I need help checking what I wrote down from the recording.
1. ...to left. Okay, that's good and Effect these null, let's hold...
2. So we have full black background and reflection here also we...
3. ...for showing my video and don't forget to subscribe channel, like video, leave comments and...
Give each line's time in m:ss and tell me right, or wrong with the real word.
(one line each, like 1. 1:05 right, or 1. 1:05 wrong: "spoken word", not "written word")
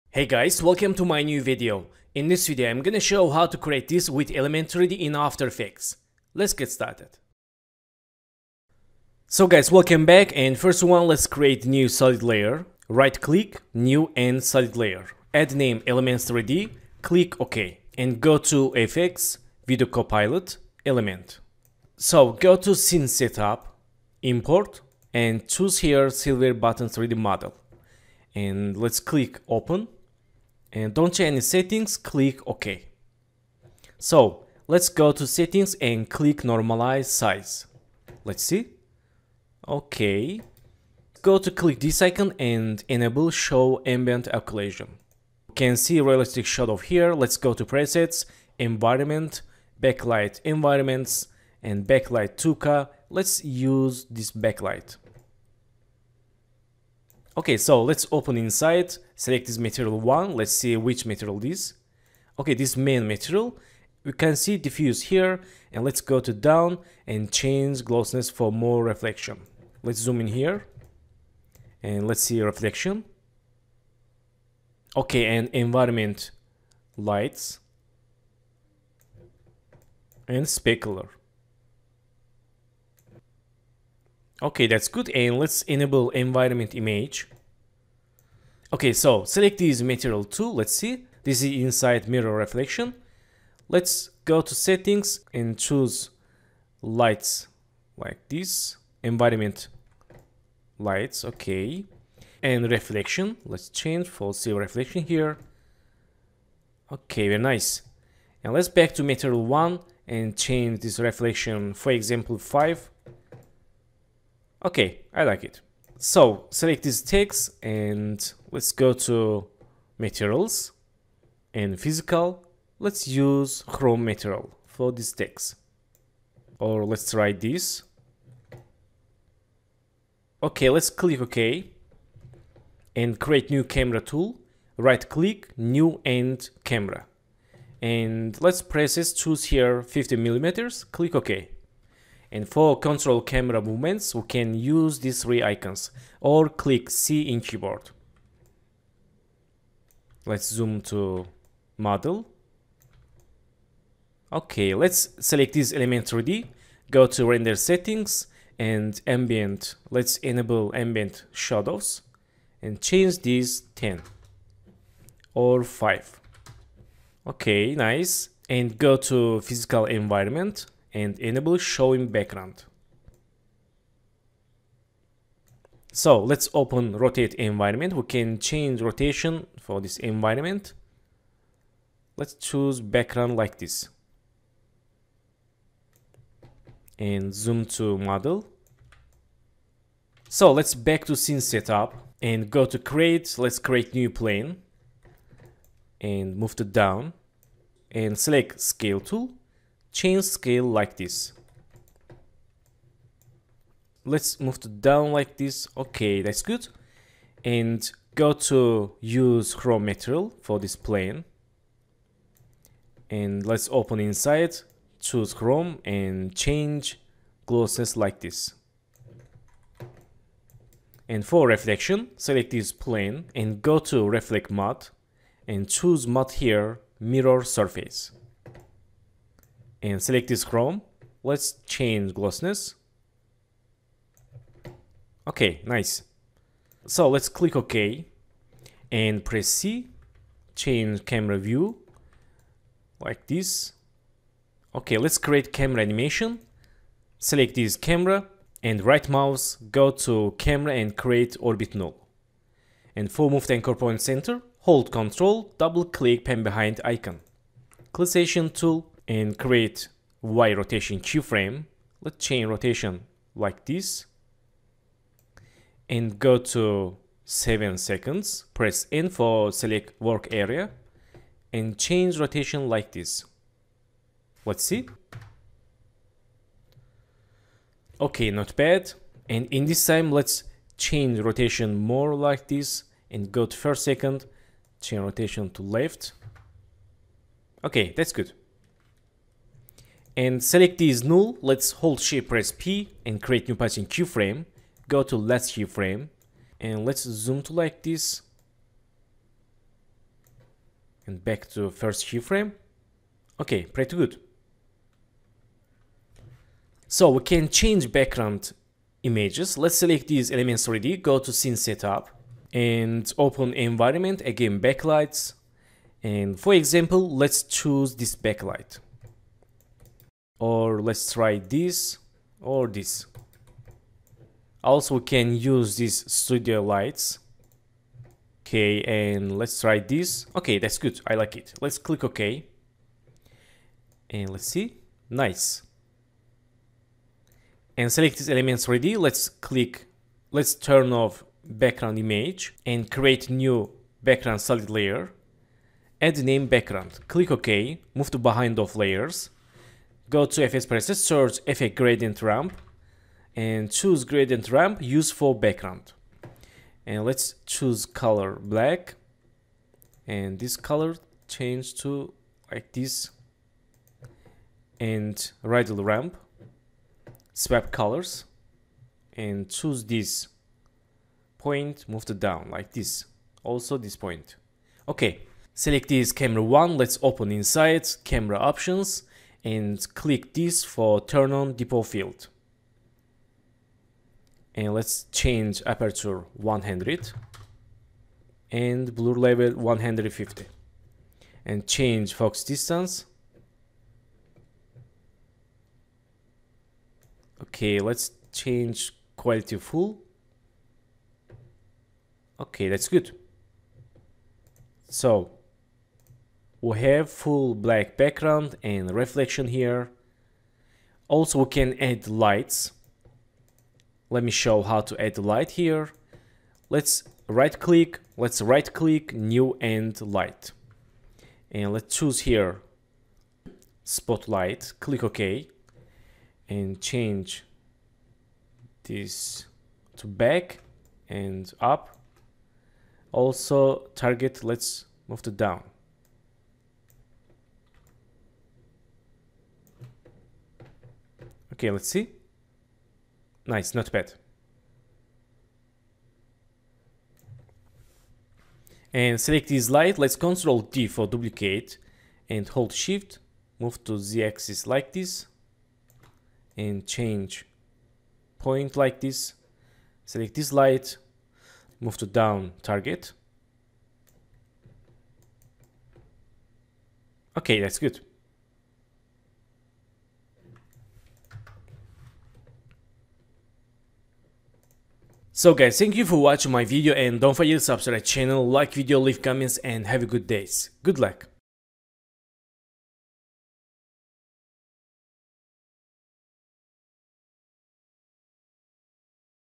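1. 4:45 wrong: "select", not "Effect"
2. 6:44 right
3. 7:56 wrong: "watching", not "showing".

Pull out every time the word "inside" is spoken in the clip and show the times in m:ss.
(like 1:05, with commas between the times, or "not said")
0:58, 1:31, 3:33, 6:17.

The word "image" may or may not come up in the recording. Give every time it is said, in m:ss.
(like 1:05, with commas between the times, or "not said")
1:26, 5:09, 5:41.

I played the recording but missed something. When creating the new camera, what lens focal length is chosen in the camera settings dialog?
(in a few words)
50 millimeters.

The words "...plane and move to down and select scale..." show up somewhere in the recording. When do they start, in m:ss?
3:14.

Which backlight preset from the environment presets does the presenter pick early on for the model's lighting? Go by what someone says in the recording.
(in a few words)
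Backlight Tuka.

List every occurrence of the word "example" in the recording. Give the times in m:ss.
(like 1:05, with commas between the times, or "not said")
1:51, 5:16.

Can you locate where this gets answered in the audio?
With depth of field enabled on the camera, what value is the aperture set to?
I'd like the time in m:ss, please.
6:25.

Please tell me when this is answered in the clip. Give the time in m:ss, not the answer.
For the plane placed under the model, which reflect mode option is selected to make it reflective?
3:47.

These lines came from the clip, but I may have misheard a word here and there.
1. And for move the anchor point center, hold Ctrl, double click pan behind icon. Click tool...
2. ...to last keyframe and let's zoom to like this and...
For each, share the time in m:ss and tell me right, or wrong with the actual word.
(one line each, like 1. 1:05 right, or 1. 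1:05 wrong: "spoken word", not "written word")
1. 4:12 right
2. 4:55 right.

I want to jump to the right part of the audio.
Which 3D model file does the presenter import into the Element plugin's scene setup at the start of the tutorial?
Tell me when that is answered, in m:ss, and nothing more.
0:26.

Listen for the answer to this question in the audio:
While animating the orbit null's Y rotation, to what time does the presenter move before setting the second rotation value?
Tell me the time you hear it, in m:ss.
4:27.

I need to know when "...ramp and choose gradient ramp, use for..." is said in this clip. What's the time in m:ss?
5:52.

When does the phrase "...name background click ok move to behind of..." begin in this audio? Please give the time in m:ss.
5:46.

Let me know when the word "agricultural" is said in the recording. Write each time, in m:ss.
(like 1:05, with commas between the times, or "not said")
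not said.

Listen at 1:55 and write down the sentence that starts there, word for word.
So select these tags and let's go to materials and physical.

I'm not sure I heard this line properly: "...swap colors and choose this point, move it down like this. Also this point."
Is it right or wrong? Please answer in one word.
right.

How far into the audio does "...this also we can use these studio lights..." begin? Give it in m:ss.
5:22.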